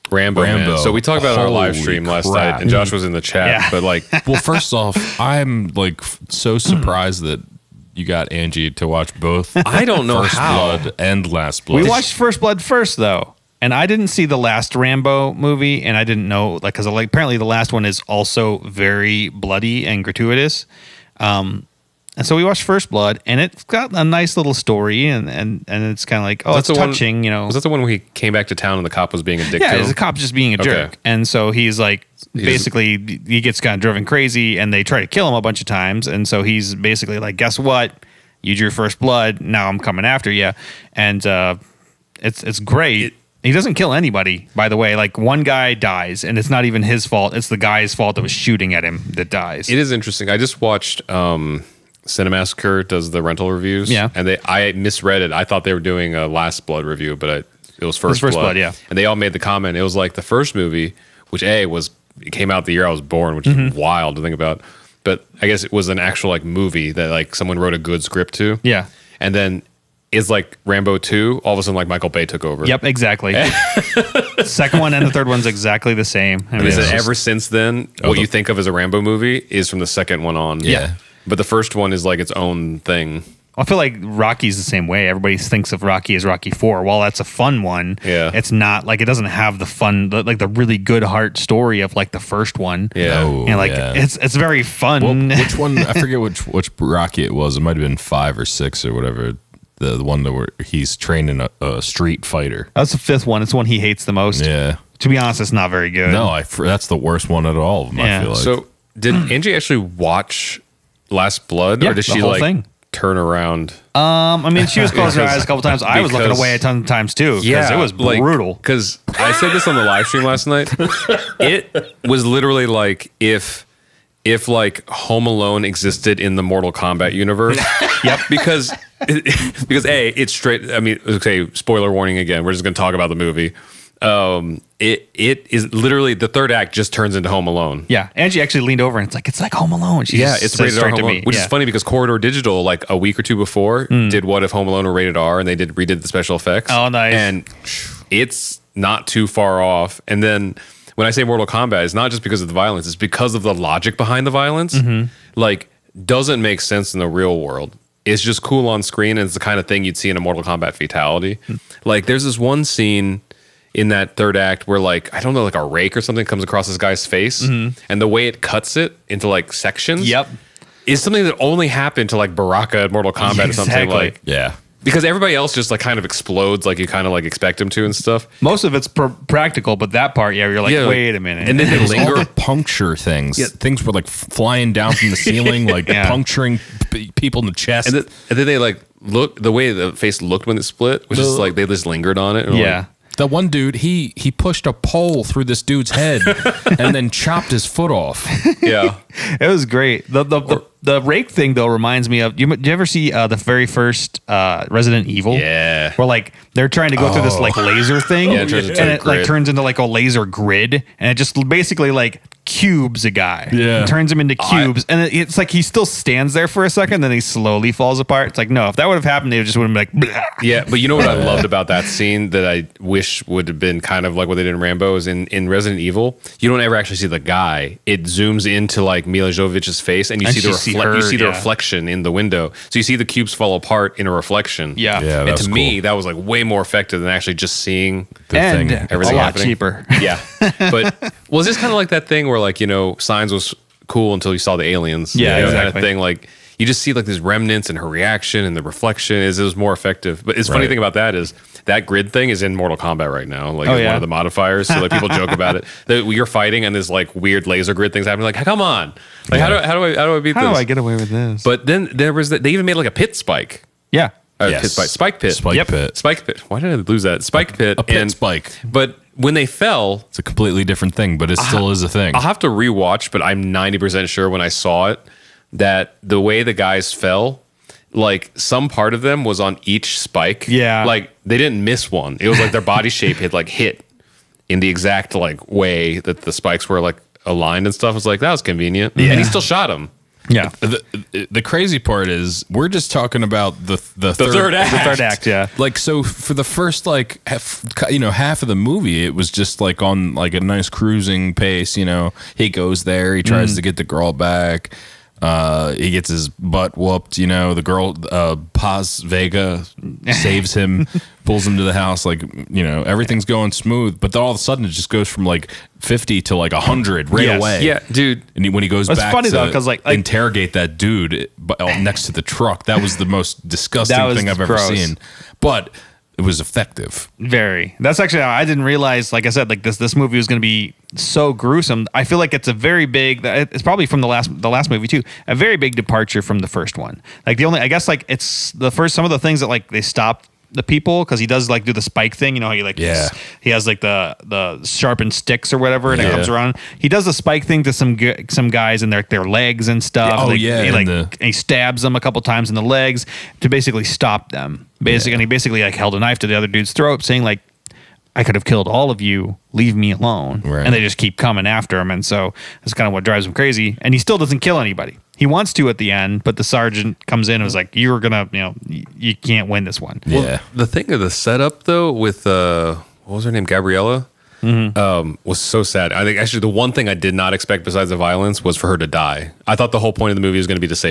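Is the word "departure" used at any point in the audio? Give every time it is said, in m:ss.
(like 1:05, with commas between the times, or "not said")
5:35.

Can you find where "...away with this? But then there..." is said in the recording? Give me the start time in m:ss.
4:20.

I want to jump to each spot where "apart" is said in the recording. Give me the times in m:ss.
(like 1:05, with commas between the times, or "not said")
3:37, 3:53.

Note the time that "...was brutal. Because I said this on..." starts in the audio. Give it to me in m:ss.
1:57.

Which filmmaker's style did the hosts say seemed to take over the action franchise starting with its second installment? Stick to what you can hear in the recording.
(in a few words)
Michael Bay.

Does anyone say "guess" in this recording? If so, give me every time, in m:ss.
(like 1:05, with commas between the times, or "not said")
0:37, 1:05, 5:37.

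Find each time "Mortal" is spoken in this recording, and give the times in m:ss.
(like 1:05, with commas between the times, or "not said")
2:06, 2:31, 2:40, 2:52, 4:12.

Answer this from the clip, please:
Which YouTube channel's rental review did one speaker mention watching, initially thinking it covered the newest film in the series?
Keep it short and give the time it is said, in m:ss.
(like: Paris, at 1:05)
Cinemassacre, at 0:52.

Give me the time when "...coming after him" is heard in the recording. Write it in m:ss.
6:01.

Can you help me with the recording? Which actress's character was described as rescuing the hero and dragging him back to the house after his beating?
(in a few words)
Paz Vega.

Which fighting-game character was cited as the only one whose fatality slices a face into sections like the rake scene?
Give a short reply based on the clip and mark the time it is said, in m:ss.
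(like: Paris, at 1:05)
Baraka, at 2:52.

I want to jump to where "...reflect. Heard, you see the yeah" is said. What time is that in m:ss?
3:50.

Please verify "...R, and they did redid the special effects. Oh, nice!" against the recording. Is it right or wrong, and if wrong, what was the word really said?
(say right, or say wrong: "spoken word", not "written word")
right.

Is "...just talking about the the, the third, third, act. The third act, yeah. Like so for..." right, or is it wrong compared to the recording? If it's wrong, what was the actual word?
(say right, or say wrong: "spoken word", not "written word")
right.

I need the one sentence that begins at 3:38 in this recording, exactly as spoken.
It's like no, if that would have happened, they just would have been like.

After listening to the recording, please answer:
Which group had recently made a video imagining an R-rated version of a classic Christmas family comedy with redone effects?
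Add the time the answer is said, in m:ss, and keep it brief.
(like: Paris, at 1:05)
Corridor Digital, at 2:21.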